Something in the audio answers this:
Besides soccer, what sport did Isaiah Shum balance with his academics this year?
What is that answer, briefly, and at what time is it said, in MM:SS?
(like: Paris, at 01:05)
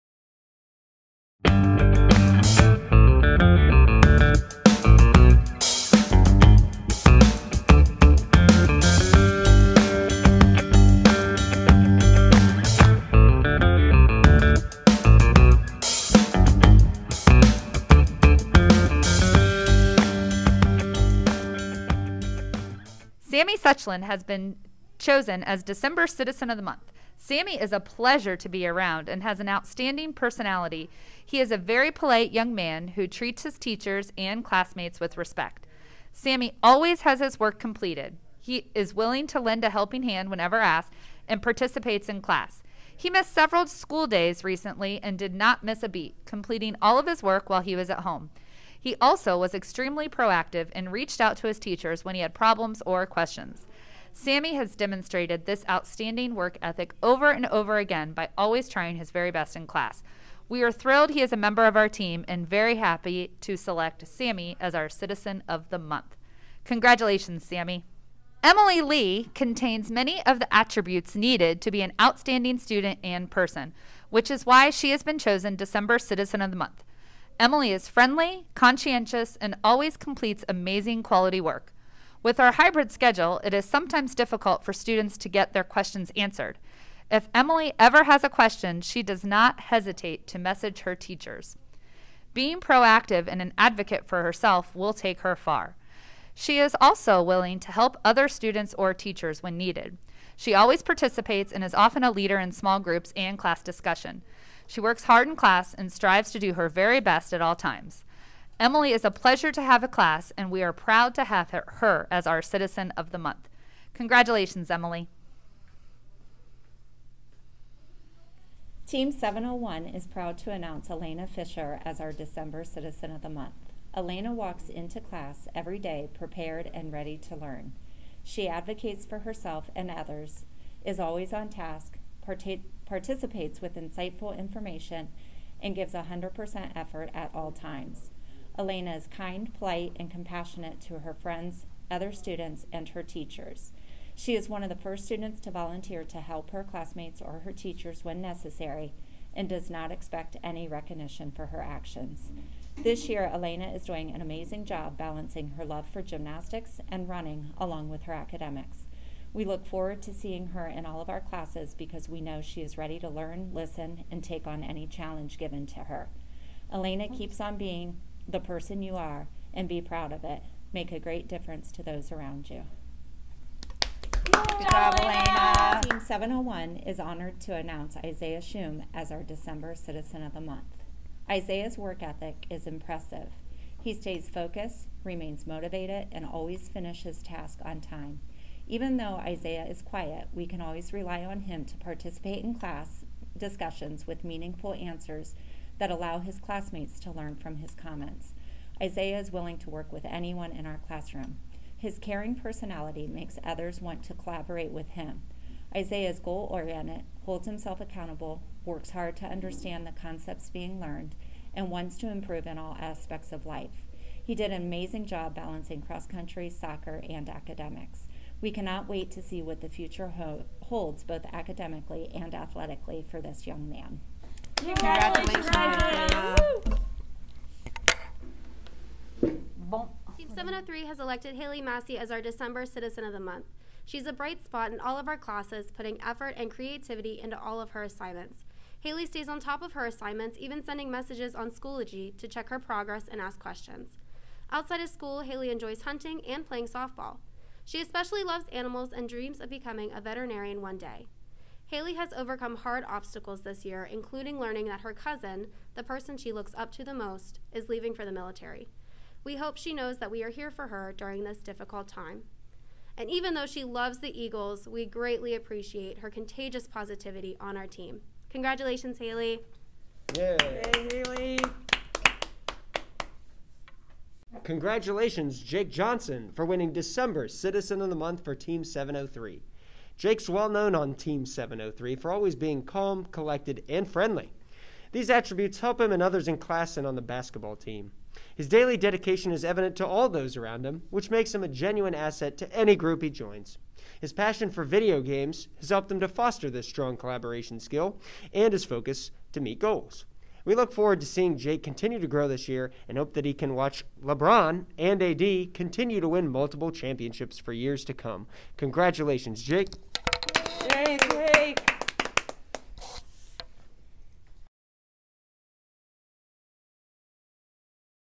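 cross country, at 03:35.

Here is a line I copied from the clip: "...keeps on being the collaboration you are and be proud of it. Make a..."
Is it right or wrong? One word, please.
wrong.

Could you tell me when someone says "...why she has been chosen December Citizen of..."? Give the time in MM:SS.
01:14.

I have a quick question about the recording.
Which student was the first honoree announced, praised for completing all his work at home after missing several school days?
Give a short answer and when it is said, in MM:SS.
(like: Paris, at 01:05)
Sammy Suchland, at 00:23.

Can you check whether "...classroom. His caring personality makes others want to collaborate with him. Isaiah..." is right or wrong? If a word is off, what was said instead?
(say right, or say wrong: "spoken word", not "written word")
right.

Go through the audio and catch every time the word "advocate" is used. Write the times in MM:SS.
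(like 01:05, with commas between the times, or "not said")
01:33, 02:08.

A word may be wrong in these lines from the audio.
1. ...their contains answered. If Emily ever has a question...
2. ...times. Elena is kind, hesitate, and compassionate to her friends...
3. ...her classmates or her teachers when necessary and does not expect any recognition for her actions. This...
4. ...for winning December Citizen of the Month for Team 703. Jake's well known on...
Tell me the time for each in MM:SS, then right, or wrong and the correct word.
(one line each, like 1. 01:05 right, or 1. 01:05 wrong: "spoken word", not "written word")
1. 01:25 wrong: "questions", not "contains"
2. 02:17 wrong: "polite", not "hesitate"
3. 02:26 right
4. 04:36 right.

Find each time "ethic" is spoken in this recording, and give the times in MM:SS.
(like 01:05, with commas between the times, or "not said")
00:56, 03:02.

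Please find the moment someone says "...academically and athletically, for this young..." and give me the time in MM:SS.
03:41.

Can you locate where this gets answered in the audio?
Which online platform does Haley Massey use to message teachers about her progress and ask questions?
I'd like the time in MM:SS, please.
04:01.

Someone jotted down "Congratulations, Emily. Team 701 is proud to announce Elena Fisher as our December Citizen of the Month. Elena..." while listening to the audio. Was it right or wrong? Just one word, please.
right.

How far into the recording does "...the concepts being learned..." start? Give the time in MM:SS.
03:29.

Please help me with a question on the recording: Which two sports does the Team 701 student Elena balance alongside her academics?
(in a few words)
gymnastics and running.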